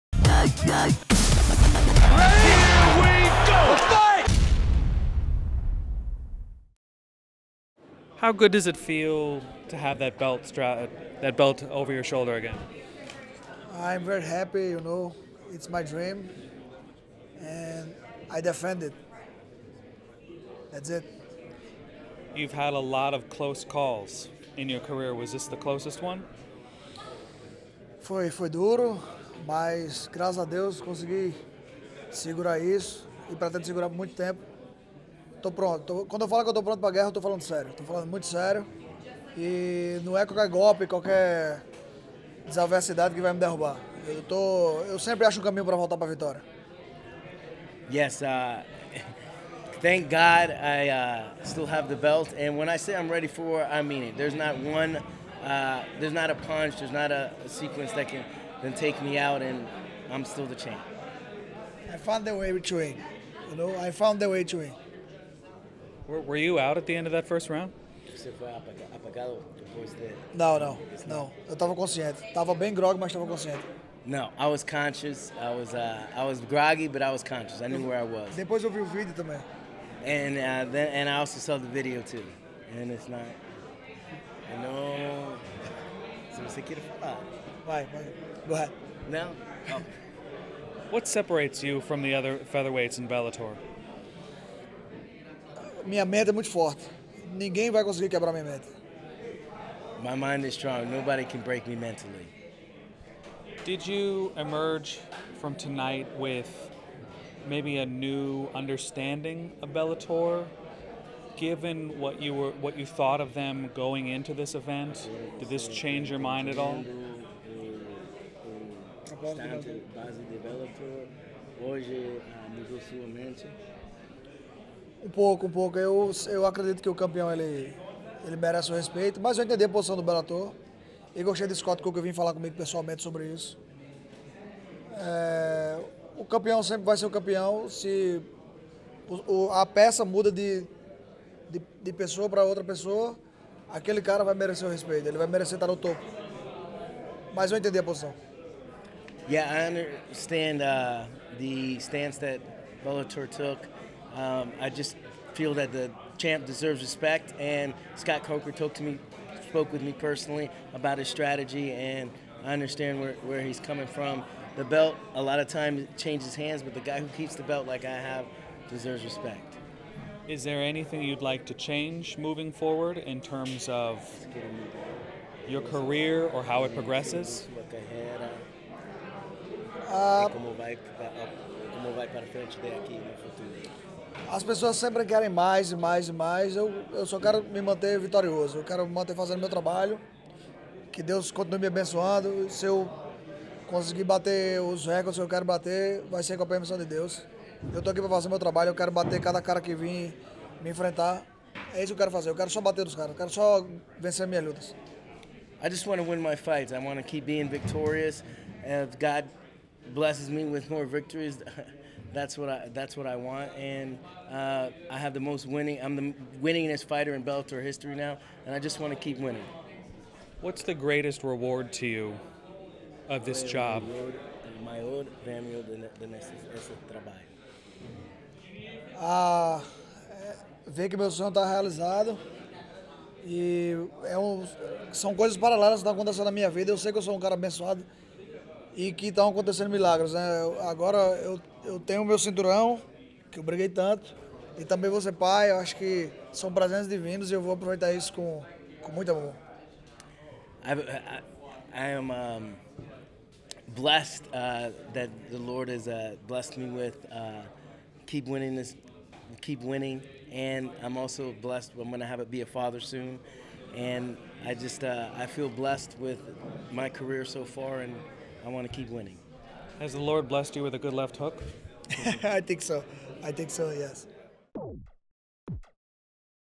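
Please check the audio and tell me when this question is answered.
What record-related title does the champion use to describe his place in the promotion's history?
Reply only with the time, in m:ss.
3:36.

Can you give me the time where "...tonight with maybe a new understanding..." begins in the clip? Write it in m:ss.
1:45.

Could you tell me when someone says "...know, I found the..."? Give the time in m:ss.
1:03.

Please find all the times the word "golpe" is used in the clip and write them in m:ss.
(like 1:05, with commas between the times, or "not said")
0:40.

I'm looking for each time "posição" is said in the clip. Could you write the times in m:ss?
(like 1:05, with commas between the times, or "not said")
2:09, 2:27.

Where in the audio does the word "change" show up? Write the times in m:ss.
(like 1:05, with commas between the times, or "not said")
1:55, 2:45, 2:51.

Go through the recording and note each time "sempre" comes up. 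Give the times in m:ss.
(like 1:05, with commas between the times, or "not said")
0:44, 2:16, 3:04.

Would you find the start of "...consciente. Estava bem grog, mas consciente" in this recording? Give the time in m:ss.
1:11.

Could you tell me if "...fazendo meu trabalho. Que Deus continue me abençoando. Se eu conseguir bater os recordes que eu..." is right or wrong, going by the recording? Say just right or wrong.
right.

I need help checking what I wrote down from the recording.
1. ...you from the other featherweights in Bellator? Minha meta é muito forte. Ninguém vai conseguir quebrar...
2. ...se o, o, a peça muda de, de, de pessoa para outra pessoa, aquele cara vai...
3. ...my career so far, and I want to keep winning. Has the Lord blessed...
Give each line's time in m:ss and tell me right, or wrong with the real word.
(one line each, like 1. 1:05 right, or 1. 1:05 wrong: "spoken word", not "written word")
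1. 1:31 right
2. 2:17 right
3. 4:26 right.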